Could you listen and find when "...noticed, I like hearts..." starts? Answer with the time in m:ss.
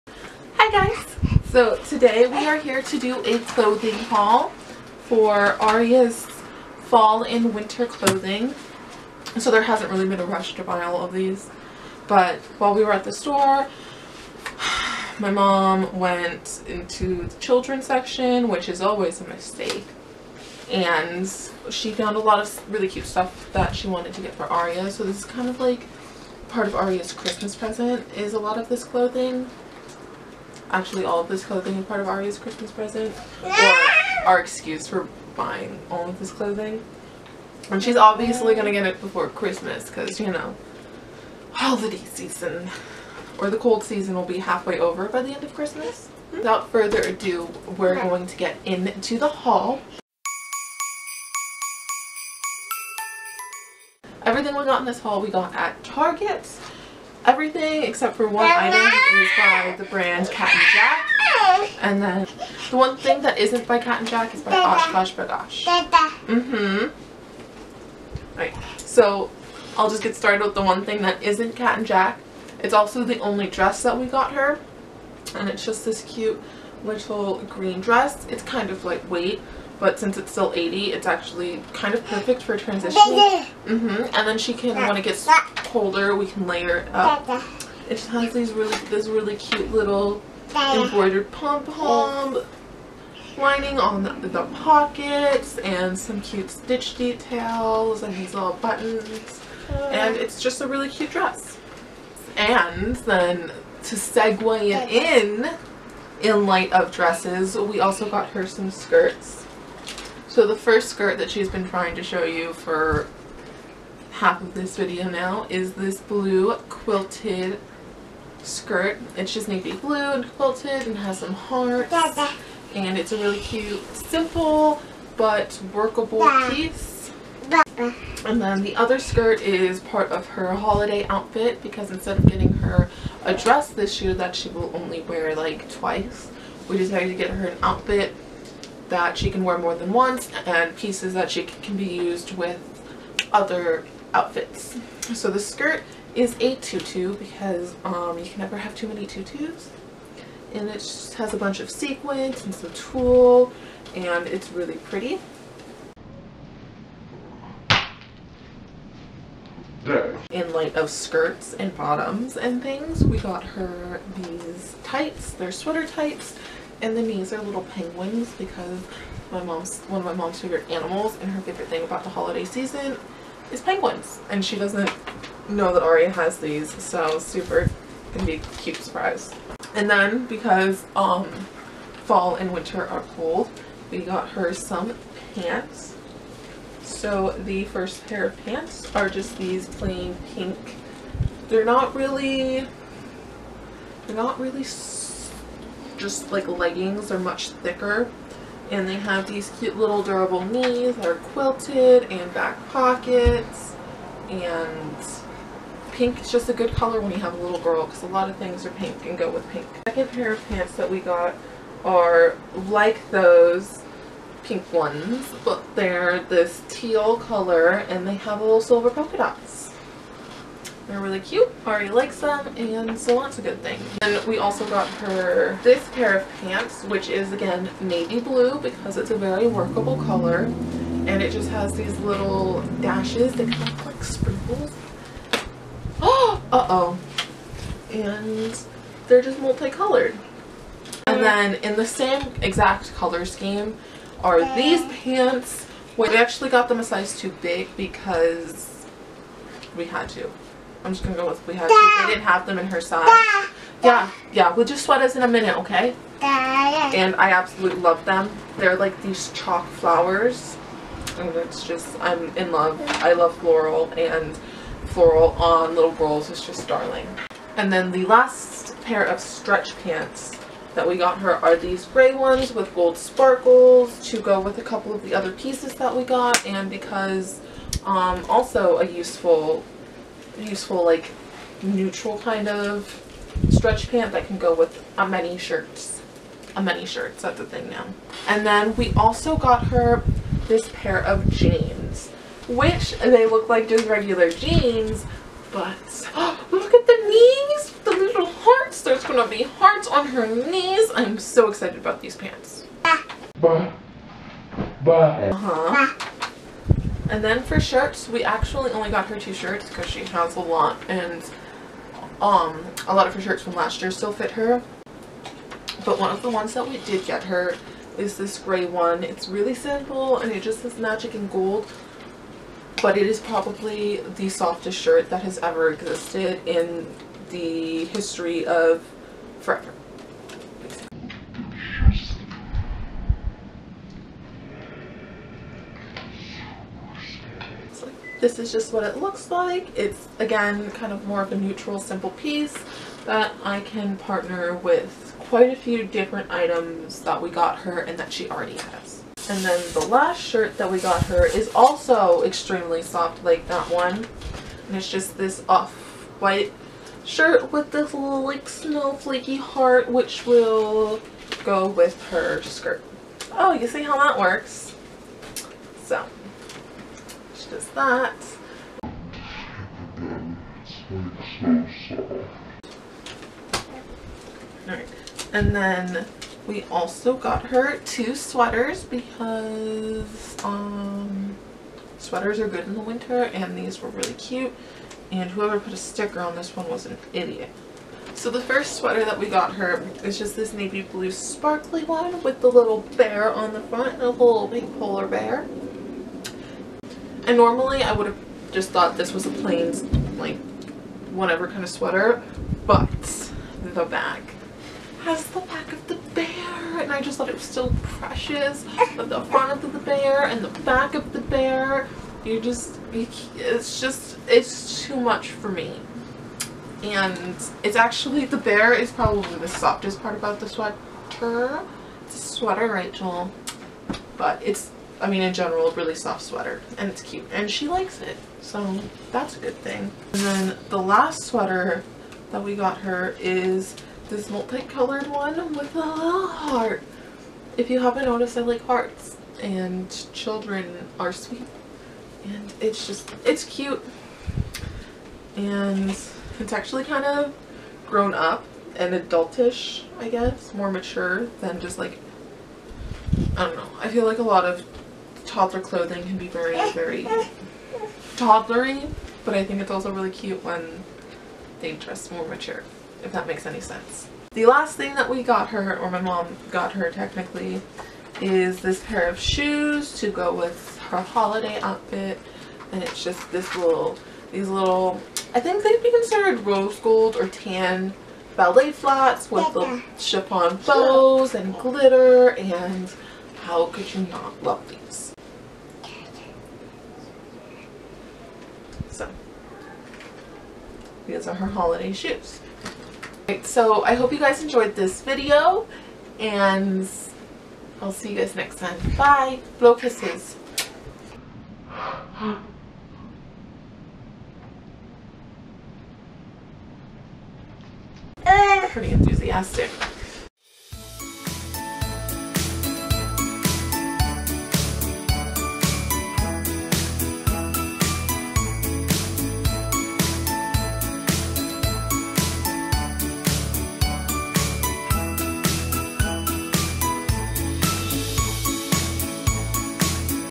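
7:18.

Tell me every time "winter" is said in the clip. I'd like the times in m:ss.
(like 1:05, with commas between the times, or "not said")
0:07, 3:02, 6:22.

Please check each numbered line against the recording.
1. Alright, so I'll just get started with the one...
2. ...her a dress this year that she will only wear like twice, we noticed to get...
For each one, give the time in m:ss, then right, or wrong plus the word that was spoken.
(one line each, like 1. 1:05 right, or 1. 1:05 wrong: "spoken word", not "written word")
1. 1:08 right
2. 2:12 wrong: "decided", not "noticed".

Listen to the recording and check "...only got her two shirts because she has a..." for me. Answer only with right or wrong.
right.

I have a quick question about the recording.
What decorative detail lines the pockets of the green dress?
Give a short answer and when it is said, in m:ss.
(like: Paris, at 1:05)
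embroidered pom-pom lining, at 1:30.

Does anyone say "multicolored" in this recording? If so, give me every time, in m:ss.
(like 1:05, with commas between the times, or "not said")
3:59, 7:14.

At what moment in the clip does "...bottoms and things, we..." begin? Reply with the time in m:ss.
2:41.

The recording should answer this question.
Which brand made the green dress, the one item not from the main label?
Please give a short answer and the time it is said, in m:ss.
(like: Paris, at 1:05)
OshKosh B'gosh, at 1:04.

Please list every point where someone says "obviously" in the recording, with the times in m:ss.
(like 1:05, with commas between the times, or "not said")
0:37.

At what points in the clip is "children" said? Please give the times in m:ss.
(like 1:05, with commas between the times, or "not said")
0:17, 7:20.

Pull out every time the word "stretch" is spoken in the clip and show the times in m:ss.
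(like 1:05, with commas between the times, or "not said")
4:29, 4:43.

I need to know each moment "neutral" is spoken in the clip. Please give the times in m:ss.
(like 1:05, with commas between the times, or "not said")
4:41, 5:41.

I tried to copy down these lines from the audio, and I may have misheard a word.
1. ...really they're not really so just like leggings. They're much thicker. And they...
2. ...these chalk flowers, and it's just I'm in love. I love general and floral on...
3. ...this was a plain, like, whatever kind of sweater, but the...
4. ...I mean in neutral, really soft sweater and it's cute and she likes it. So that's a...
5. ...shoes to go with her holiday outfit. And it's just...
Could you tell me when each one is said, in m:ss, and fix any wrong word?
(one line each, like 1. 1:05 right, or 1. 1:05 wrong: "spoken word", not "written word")
1. 3:11 right
2. 4:19 wrong: "floral", not "general"
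3. 6:38 right
4. 7:05 wrong: "general", not "neutral"
5. 7:49 right.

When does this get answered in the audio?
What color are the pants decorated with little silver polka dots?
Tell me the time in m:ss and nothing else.
3:36.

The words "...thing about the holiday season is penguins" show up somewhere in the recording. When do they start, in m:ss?
2:51.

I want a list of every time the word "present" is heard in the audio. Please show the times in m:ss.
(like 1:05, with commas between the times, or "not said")
0:27, 0:32.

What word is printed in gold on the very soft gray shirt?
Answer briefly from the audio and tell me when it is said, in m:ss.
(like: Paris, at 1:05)
magic, at 5:20.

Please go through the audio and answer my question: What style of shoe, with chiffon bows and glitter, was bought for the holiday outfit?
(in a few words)
ballet flats.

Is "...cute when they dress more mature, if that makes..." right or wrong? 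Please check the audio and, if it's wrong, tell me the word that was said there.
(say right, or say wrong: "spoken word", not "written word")
right.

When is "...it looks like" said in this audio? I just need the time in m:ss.
5:38.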